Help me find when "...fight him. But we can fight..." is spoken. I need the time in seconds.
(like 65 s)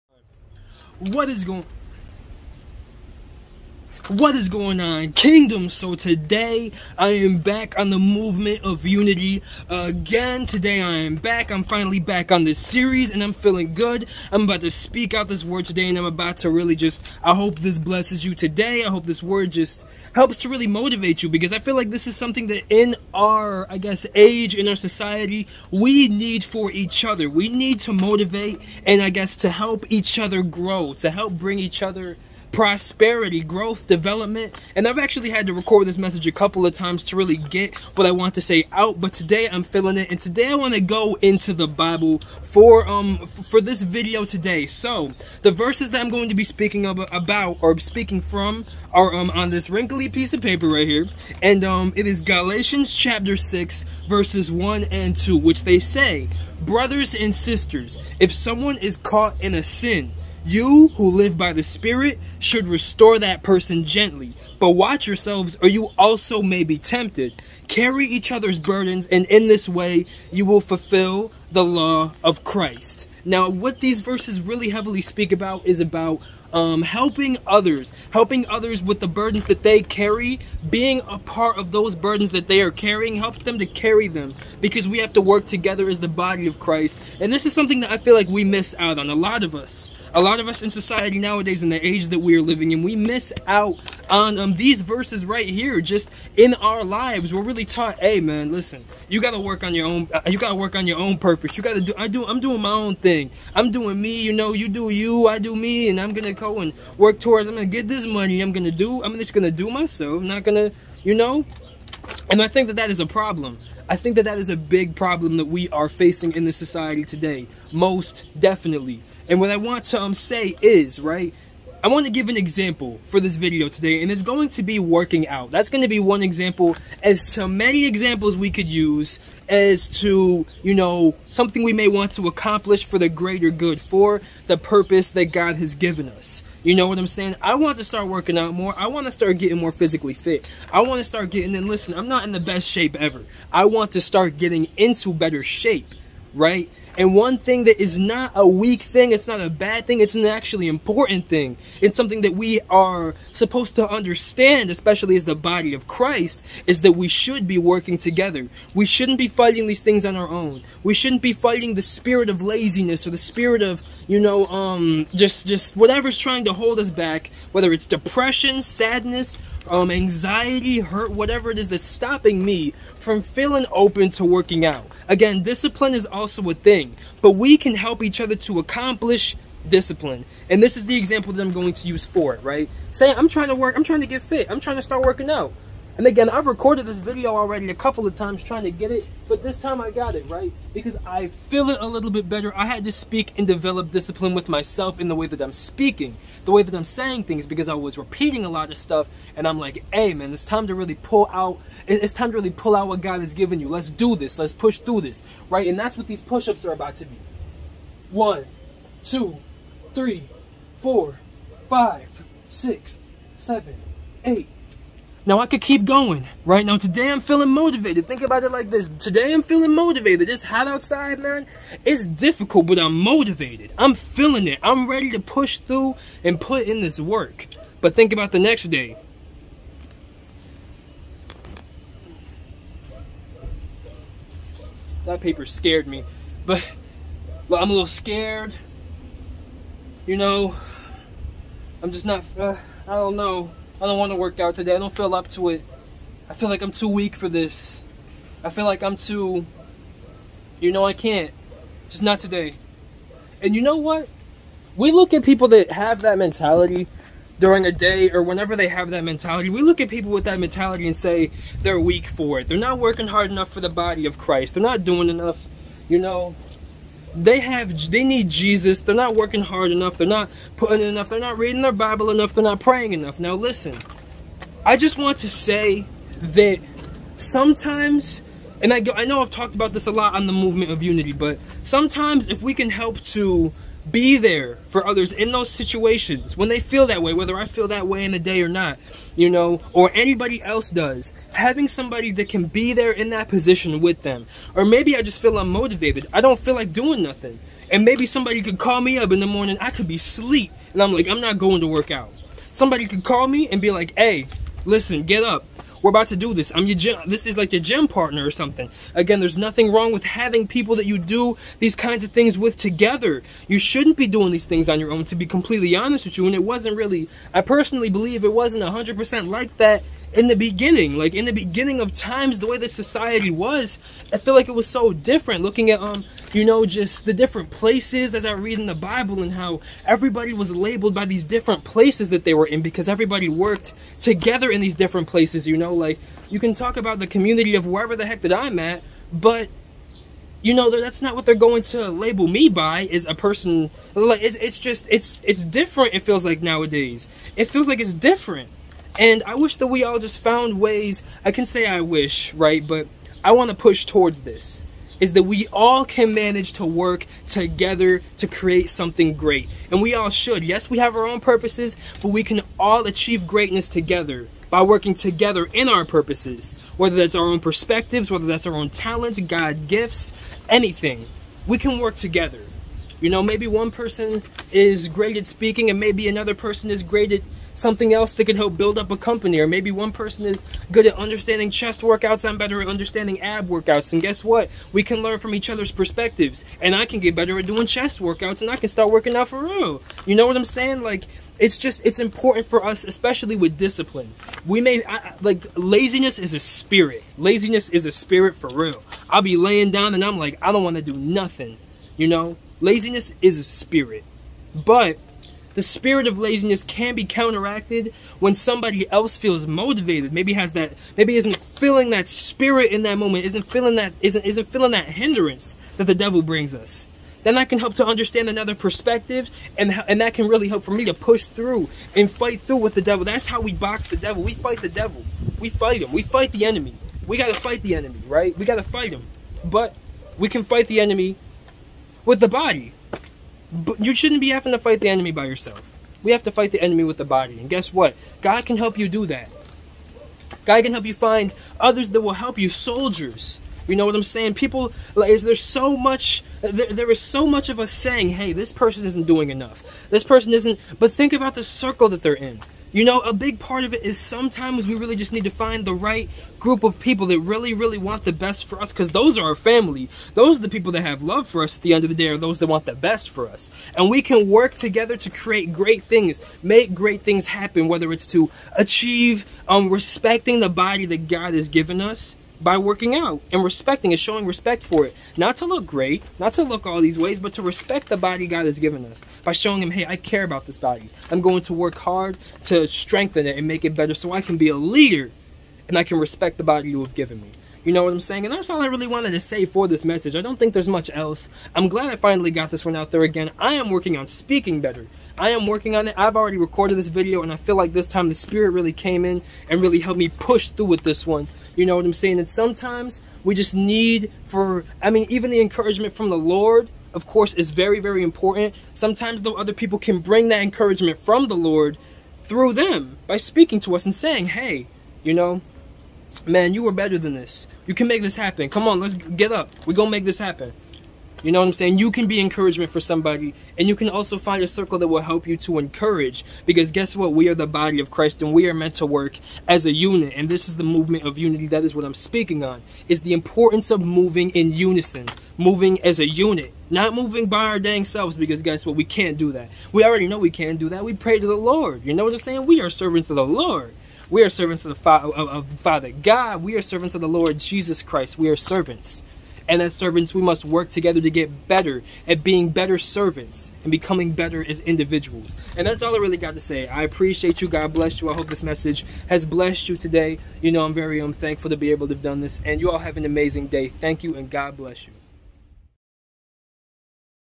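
428 s.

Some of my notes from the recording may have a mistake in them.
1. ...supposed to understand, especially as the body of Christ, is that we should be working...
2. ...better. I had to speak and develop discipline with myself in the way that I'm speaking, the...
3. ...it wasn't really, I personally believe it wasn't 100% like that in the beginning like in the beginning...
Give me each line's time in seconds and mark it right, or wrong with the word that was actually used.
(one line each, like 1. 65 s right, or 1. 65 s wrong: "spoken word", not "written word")
1. 153 s right
2. 192 s right
3. 316 s right.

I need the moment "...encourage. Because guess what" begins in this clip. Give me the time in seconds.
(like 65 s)
525 s.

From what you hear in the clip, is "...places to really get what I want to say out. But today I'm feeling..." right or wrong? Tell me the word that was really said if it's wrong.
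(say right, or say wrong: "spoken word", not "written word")
wrong: "times", not "places".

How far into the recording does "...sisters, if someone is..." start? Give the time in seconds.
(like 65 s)
57 s.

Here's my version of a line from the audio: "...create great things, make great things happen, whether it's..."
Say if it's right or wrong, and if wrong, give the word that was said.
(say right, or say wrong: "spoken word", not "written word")
right.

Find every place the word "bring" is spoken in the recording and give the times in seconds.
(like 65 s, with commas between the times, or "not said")
31 s, 416 s, 509 s.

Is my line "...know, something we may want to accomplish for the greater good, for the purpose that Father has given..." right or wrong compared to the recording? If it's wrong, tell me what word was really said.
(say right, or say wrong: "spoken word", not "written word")
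wrong: "God", not "Father".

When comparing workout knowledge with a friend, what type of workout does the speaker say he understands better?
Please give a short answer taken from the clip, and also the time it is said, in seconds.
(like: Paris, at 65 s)
ab workouts, at 383 s.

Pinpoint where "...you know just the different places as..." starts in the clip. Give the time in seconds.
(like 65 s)
326 s.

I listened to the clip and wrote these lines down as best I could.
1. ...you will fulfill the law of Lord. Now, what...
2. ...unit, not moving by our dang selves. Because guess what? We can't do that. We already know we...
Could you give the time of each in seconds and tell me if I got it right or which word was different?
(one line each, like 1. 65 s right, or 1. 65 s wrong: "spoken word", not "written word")
1. 70 s wrong: "Christ", not "Lord"
2. 536 s right.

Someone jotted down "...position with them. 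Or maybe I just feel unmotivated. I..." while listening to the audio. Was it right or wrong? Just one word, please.
right.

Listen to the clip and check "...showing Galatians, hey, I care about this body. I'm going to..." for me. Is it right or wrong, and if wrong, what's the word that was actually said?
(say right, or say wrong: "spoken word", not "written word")
wrong: "Him", not "Galatians".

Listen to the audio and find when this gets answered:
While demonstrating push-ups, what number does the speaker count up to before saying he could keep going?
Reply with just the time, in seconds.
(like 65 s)
214 s.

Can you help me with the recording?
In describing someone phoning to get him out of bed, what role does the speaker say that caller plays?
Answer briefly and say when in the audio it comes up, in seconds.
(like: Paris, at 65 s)
gym partner, at 307 s.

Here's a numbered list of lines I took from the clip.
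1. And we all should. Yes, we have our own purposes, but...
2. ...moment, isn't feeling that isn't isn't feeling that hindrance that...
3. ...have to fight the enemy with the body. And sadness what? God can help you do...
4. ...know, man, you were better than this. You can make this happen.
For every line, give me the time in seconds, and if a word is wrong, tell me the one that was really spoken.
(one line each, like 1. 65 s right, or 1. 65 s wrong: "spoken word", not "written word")
1. 359 s right
2. 412 s right
3. 436 s wrong: "guess", not "sadness"
4. 515 s right.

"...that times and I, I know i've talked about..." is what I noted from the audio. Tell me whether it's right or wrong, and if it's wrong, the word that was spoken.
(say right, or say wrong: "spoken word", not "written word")
wrong: "sometimes", not "times".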